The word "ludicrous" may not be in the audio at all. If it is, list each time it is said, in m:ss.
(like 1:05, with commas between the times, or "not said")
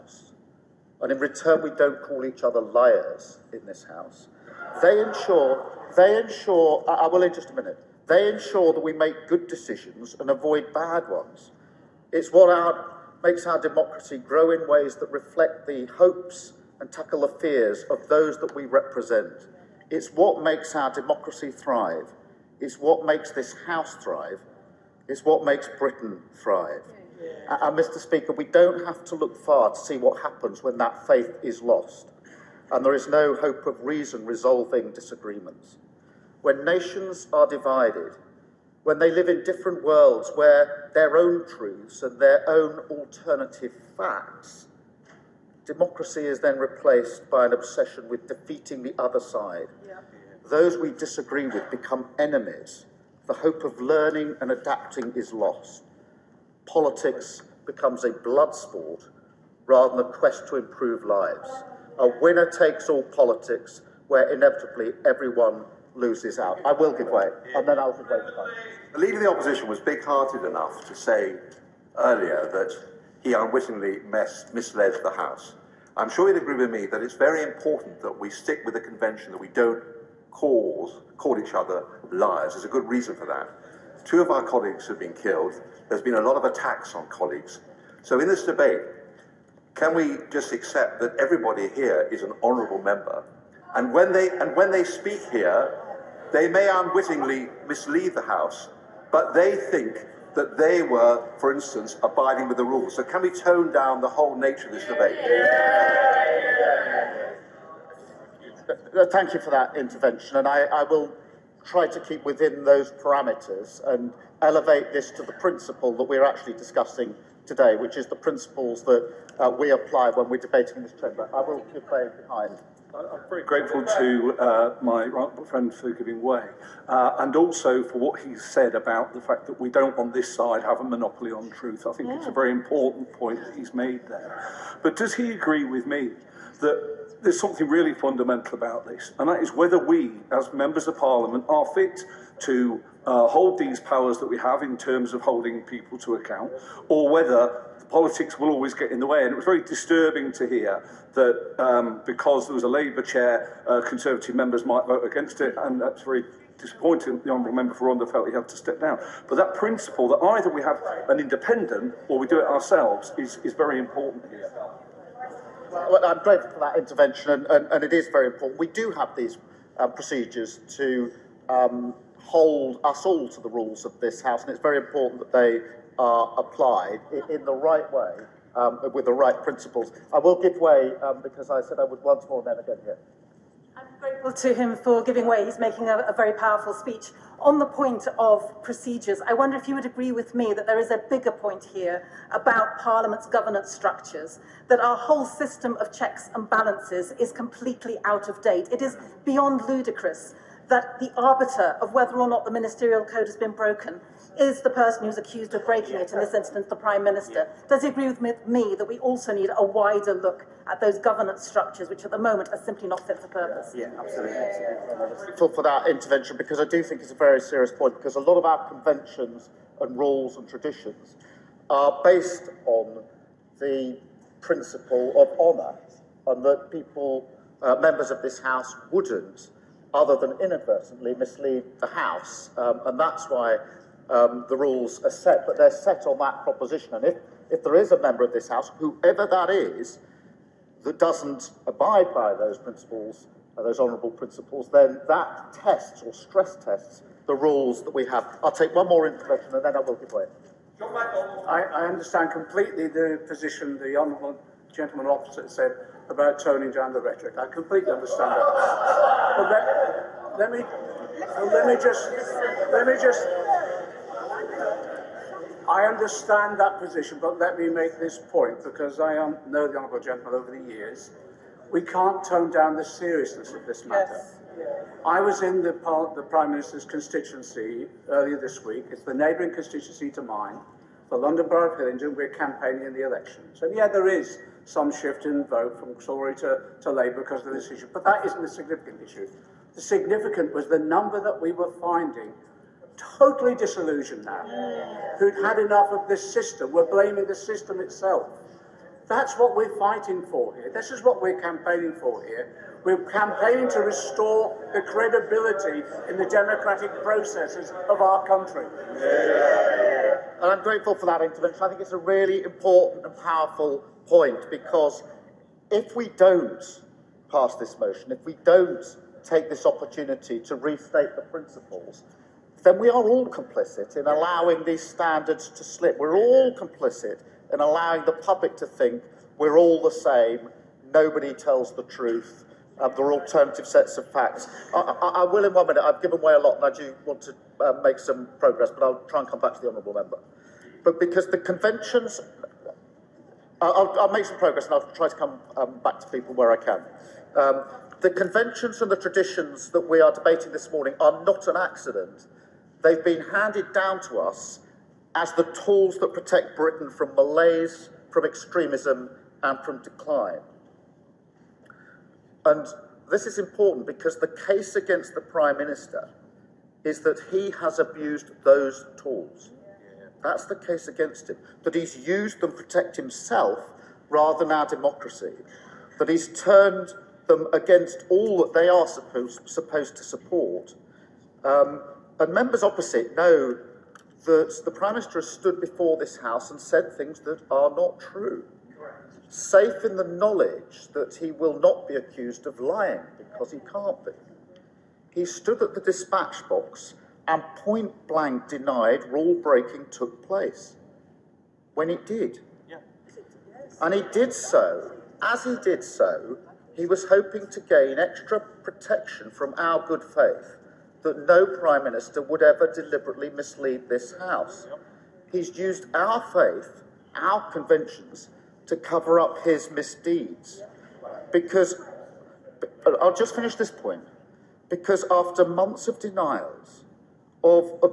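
3:19.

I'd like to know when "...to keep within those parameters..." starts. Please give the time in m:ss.
1:51.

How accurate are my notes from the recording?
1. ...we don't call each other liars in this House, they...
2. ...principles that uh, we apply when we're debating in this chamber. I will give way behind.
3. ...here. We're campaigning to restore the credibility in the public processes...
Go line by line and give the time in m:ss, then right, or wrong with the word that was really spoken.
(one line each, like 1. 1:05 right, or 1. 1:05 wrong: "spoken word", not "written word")
1. 0:01 right
2. 1:58 right
3. 5:02 wrong: "democratic", not "public".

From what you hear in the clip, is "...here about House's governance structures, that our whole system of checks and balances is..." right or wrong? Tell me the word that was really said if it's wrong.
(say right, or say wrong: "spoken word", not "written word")
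wrong: "Parliament", not "House".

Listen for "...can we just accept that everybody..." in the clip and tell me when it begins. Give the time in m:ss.
1:29.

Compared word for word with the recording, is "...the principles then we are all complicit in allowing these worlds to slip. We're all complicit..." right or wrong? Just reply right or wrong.
wrong.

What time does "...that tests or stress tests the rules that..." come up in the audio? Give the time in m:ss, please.
4:05.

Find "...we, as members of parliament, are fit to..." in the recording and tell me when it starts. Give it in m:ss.
2:19.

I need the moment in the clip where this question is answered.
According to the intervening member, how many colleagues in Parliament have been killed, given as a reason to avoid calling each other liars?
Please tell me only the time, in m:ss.
1:24.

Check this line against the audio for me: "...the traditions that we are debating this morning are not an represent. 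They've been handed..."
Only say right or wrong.
wrong.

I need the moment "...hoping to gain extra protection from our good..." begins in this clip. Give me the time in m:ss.
6:47.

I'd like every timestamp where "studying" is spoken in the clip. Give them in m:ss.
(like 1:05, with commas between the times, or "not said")
not said.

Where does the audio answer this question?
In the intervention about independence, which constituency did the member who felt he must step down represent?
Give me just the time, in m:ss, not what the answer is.
2:37.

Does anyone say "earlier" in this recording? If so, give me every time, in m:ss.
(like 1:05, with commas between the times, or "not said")
1:11, 4:38.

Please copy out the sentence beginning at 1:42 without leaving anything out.
So can we tone down the whole nature of this debate?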